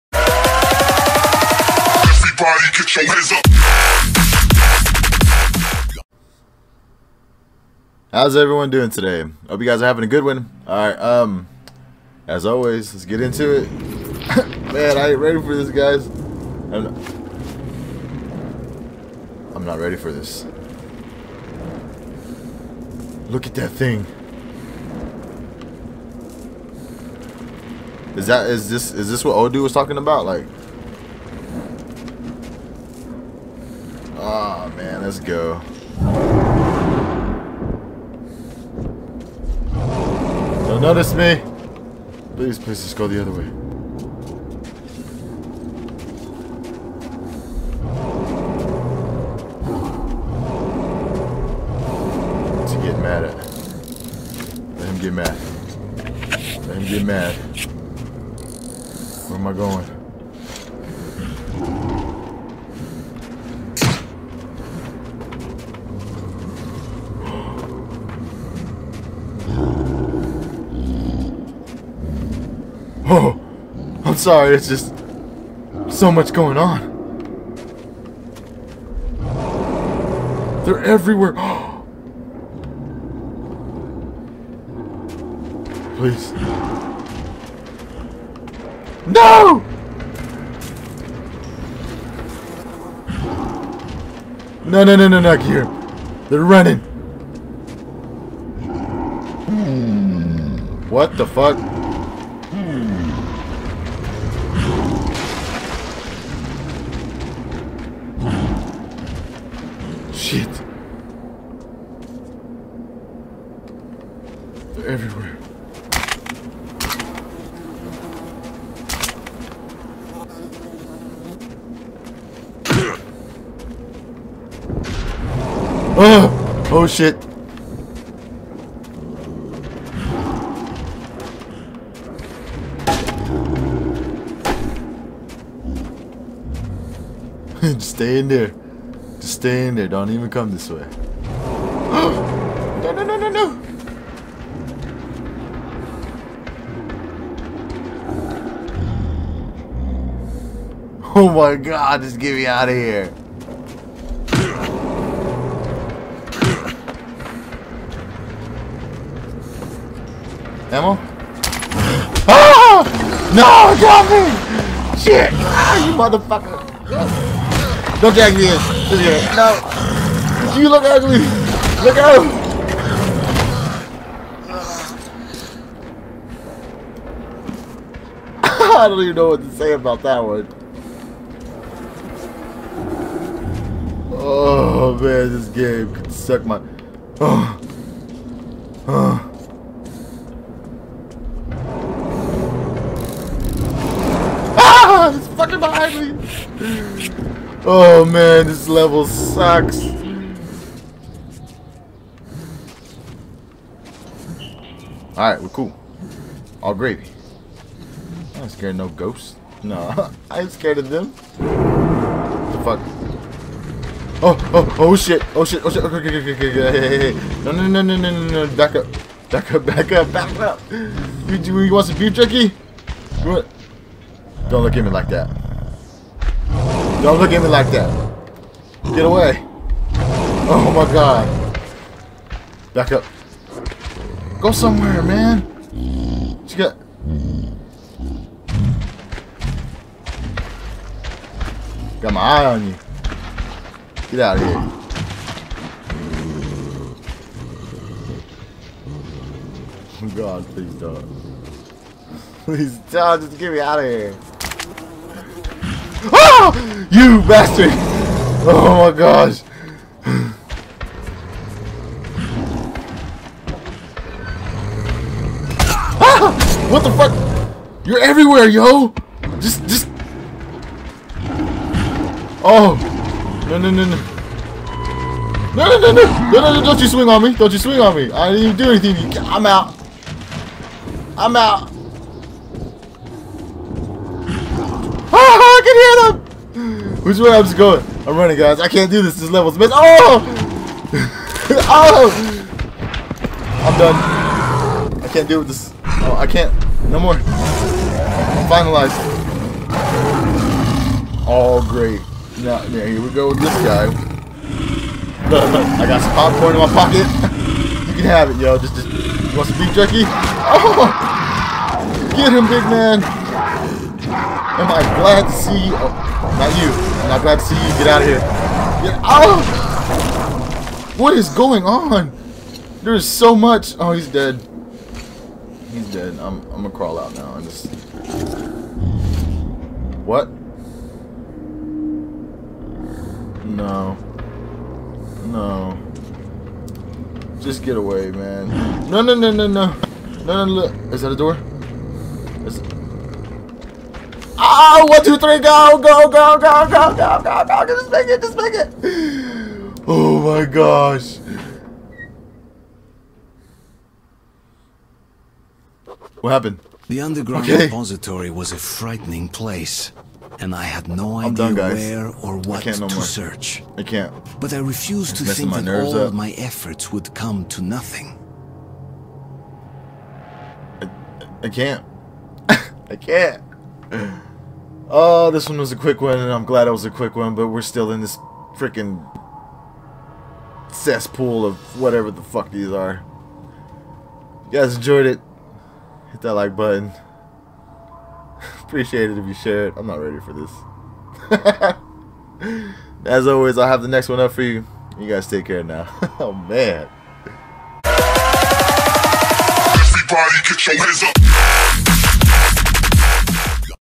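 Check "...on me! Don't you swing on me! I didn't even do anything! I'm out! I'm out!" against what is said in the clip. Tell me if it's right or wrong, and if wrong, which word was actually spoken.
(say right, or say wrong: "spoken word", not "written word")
right.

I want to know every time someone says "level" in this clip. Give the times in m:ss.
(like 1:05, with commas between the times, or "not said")
3:18, 4:49.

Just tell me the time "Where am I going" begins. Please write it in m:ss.
0:59.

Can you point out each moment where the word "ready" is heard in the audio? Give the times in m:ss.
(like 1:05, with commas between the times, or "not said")
0:15, 0:19, 6:29.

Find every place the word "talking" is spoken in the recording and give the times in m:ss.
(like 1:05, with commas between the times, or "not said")
0:29.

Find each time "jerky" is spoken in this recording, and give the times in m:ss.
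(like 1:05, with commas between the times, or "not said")
3:42, 5:09.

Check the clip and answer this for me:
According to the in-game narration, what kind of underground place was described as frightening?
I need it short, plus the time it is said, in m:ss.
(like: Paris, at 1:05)
Repository, at 5:57.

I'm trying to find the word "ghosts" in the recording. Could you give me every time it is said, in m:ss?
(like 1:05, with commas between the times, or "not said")
3:28.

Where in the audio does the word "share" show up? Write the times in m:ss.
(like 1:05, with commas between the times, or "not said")
6:29.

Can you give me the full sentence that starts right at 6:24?
If you guys enjoyed it, hit that like button.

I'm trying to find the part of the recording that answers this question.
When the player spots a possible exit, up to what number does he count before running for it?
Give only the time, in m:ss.
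5:45.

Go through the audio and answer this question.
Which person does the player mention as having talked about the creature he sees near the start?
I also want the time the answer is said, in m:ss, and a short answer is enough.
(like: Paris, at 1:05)
Odu, at 0:29.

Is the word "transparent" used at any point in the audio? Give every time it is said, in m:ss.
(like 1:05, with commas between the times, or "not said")
not said.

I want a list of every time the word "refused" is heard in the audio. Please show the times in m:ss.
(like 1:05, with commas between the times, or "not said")
6:04.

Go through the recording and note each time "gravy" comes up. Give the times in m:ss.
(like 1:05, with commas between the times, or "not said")
3:26.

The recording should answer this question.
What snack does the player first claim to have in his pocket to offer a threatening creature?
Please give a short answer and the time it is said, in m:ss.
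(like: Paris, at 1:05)
Popcorn, at 5:06.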